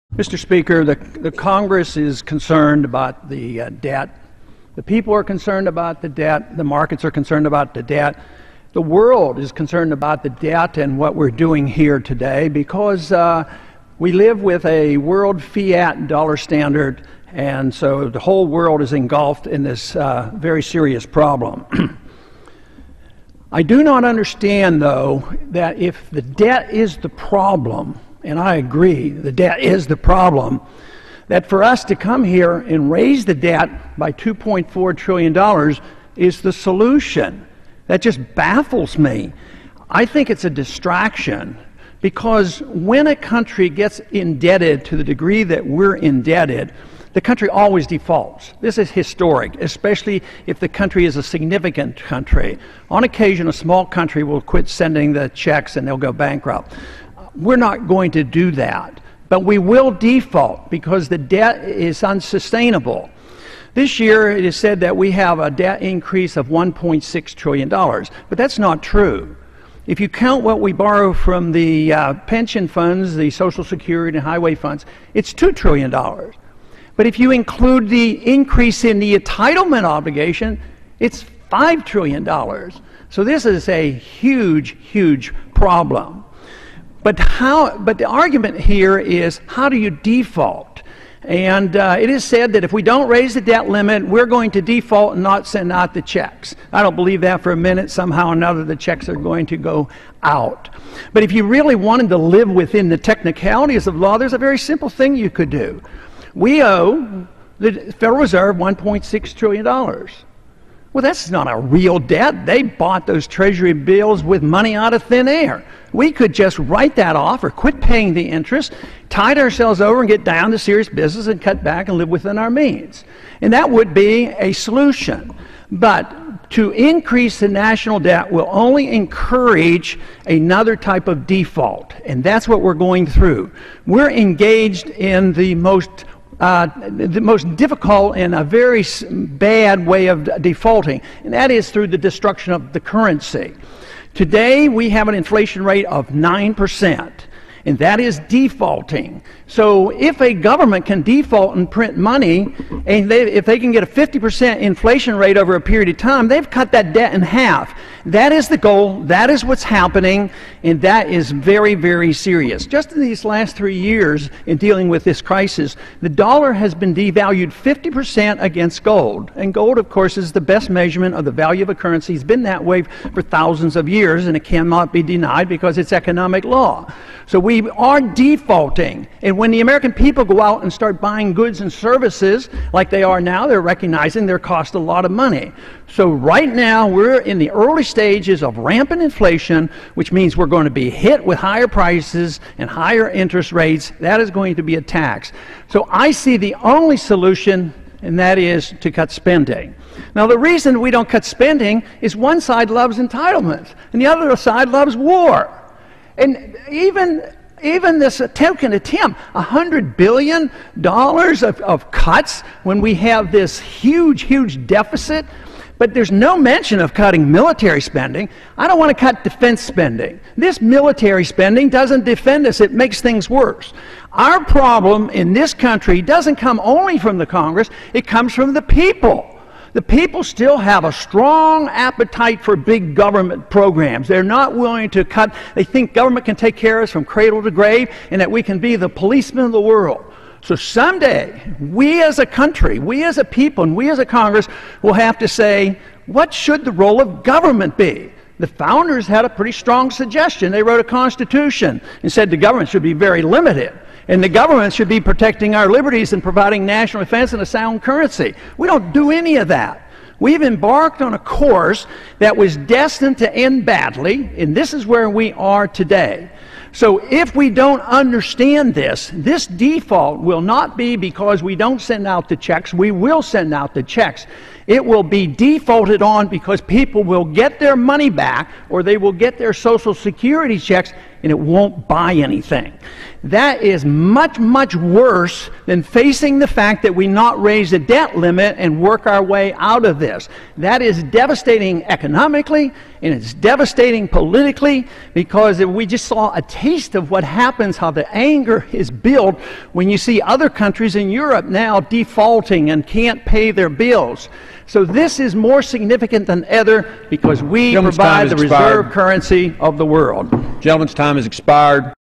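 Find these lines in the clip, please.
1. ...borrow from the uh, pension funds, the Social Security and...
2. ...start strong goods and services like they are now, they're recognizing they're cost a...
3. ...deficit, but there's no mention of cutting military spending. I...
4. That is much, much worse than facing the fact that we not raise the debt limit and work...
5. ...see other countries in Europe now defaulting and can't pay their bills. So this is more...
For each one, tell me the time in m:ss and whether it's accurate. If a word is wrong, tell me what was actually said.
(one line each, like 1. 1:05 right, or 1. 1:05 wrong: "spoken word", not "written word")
1. 1:10 right
2. 3:00 wrong: "buying", not "strong"
3. 3:34 right
4. 4:43 right
5. 4:59 right.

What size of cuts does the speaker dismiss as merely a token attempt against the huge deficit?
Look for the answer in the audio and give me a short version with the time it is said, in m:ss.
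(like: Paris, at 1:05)
$100 billion, at 3:29.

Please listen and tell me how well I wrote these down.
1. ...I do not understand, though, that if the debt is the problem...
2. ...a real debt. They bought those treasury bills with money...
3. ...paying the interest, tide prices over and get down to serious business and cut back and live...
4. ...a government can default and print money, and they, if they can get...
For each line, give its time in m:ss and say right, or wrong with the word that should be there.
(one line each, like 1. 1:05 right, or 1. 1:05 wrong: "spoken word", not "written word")
1. 0:23 right
2. 1:51 right
3. 1:57 wrong: "ourselves", not "prices"
4. 2:30 right.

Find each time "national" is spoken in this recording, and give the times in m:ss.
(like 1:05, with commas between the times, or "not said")
2:07, 4:16.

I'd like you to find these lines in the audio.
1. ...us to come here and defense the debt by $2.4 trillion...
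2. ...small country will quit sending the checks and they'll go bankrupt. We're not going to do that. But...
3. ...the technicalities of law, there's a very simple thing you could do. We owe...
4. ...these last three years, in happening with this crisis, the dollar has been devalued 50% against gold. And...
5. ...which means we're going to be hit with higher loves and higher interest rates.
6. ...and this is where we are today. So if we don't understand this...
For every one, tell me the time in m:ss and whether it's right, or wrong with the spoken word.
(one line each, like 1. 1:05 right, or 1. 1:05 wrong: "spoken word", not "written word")
1. 0:31 wrong: "raise", not "defense"
2. 0:53 right
3. 1:42 right
4. 2:43 wrong: "dealing", not "happening"
5. 3:09 wrong: "prices", not "loves"
6. 4:24 right.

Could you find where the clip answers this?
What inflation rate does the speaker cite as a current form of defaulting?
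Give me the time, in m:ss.
2:26.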